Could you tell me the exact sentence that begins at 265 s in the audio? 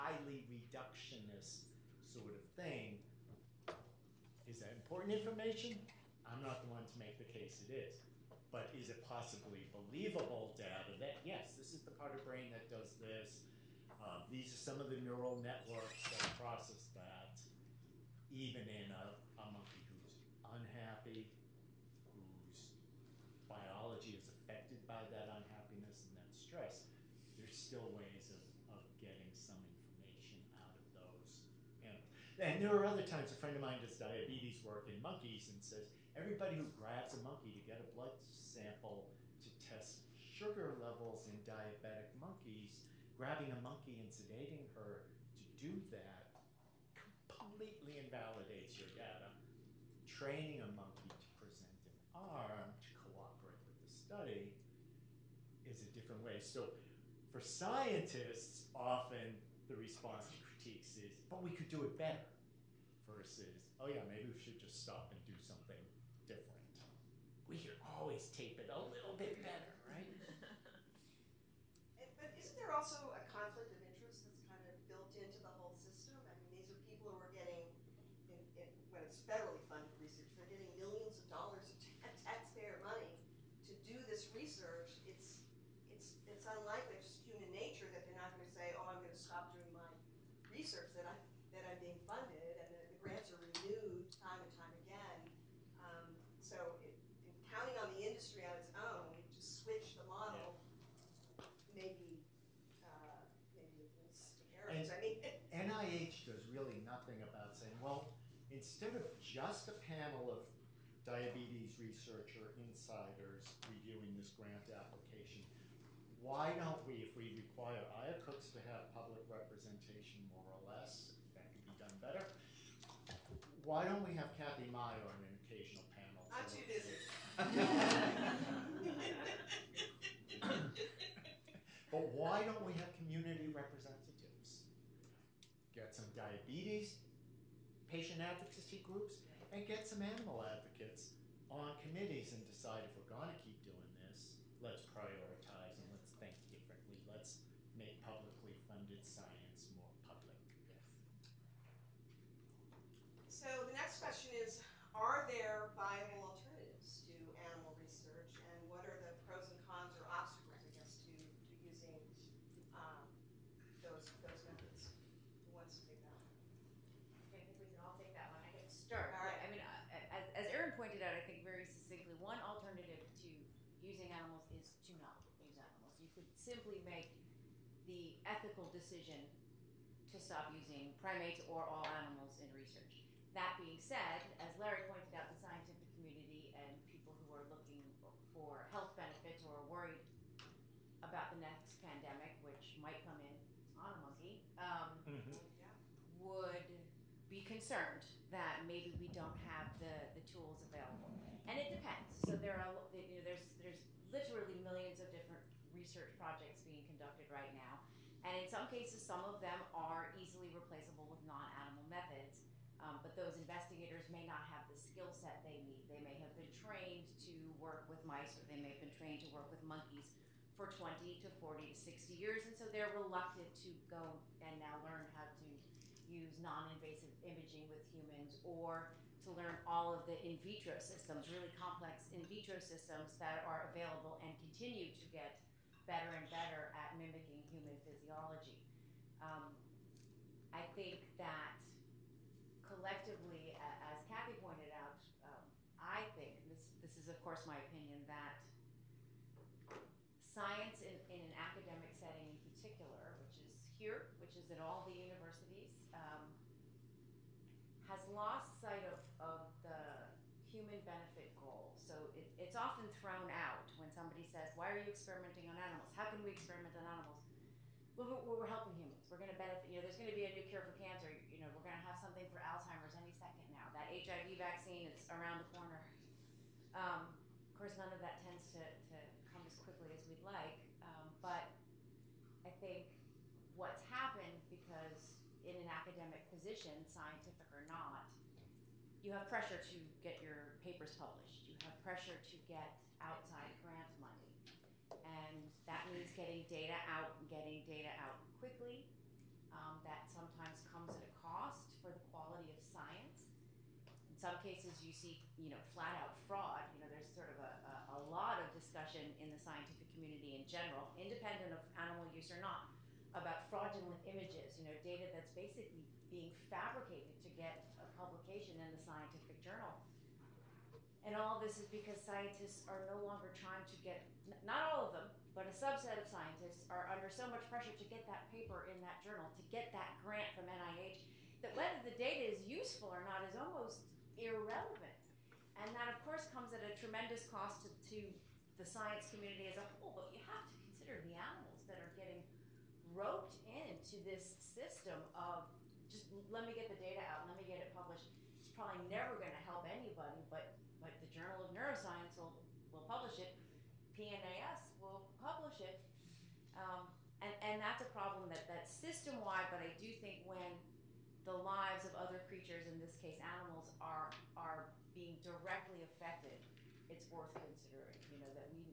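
How can we experiment on animals?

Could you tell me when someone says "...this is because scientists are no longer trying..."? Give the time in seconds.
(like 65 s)
321 s.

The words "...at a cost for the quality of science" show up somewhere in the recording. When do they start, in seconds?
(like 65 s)
300 s.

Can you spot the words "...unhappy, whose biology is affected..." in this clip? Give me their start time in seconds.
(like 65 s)
20 s.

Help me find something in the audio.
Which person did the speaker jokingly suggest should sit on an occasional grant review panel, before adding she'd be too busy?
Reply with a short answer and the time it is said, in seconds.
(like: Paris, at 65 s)
Kathy Meyer, at 124 s.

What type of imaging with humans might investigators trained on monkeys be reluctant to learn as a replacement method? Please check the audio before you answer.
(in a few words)
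non-invasive imaging.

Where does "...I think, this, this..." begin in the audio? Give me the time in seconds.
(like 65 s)
245 s.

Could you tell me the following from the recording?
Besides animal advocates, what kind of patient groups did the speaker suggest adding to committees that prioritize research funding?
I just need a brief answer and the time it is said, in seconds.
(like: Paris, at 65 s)
diabetes patient advocacy groups, at 136 s.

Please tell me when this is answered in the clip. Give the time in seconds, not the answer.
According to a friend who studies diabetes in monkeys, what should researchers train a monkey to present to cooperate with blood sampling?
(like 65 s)
51 s.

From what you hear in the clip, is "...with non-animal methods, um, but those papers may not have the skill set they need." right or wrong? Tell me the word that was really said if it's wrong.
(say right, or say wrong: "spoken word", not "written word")
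wrong: "investigators", not "papers".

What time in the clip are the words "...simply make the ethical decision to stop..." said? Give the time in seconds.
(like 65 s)
176 s.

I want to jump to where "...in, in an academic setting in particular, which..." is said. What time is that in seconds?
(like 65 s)
250 s.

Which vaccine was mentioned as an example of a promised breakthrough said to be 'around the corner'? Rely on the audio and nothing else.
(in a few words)
HIV vaccine.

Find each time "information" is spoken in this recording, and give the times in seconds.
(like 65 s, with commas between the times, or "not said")
5 s, 29 s.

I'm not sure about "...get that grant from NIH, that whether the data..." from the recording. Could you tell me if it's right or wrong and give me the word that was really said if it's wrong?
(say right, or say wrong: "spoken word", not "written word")
right.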